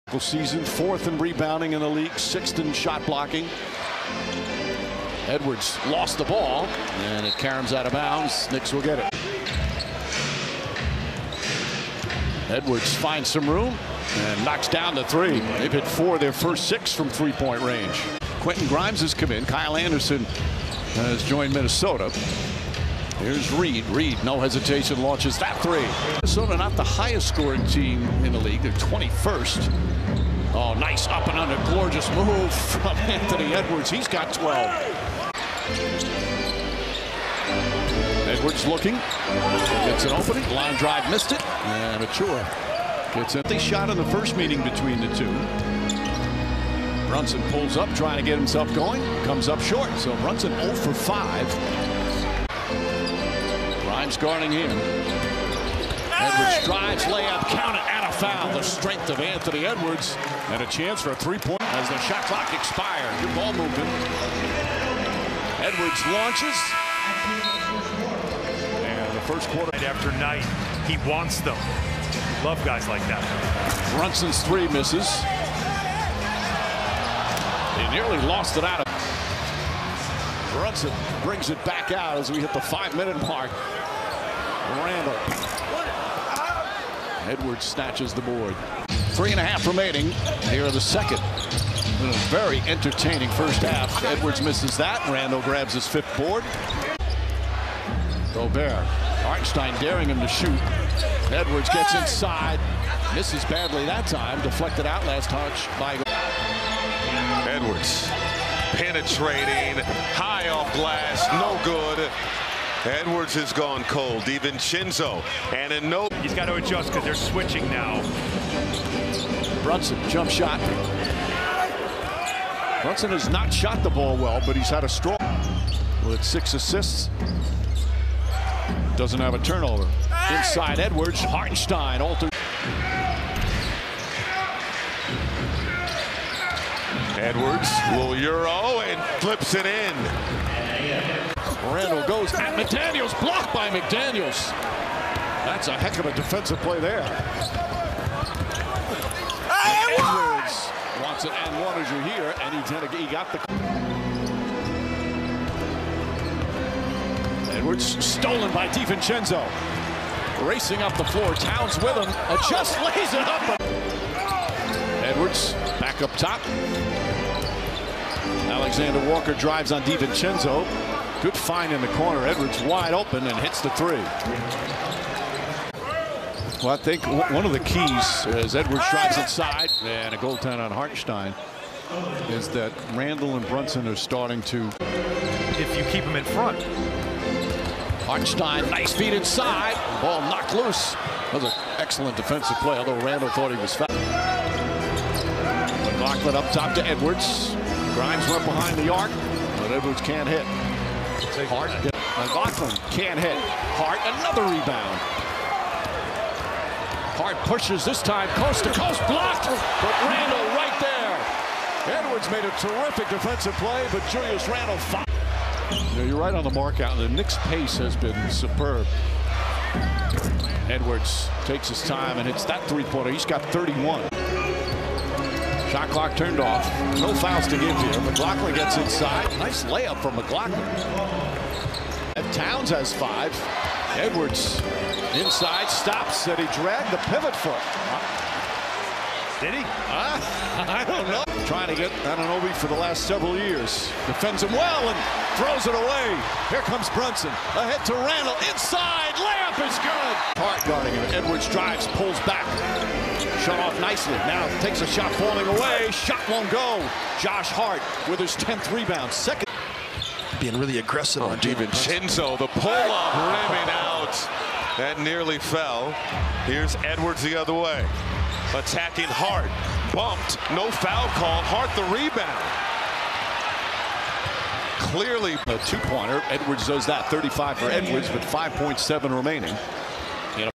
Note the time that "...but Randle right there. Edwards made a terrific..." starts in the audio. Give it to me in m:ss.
3:29.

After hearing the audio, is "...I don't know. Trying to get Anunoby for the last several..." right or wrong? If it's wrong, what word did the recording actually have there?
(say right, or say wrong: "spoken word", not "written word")
right.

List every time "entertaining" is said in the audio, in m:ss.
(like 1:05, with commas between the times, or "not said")
1:32.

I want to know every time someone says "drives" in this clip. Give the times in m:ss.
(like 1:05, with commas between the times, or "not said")
0:40, 0:56, 2:49, 2:58, 4:11.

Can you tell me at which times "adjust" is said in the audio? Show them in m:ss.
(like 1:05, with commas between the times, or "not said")
1:56.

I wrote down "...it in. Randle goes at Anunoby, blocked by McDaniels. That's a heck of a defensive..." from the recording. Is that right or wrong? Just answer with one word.
wrong.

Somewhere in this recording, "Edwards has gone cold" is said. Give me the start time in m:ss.
1:52.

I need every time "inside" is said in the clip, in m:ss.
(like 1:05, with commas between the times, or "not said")
1:41, 2:10, 2:59, 3:09, 3:48, 3:55, 4:08.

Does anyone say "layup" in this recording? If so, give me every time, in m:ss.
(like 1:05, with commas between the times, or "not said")
0:57, 3:49, 4:09.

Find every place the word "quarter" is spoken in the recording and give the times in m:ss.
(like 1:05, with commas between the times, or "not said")
1:09.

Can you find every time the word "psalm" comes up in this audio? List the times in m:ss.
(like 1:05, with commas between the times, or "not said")
not said.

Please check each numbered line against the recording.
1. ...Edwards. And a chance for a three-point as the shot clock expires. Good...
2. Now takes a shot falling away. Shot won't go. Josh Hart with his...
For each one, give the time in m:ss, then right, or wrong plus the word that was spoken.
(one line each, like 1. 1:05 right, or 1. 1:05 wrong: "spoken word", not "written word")
1. 0:59 right
2. 4:14 right.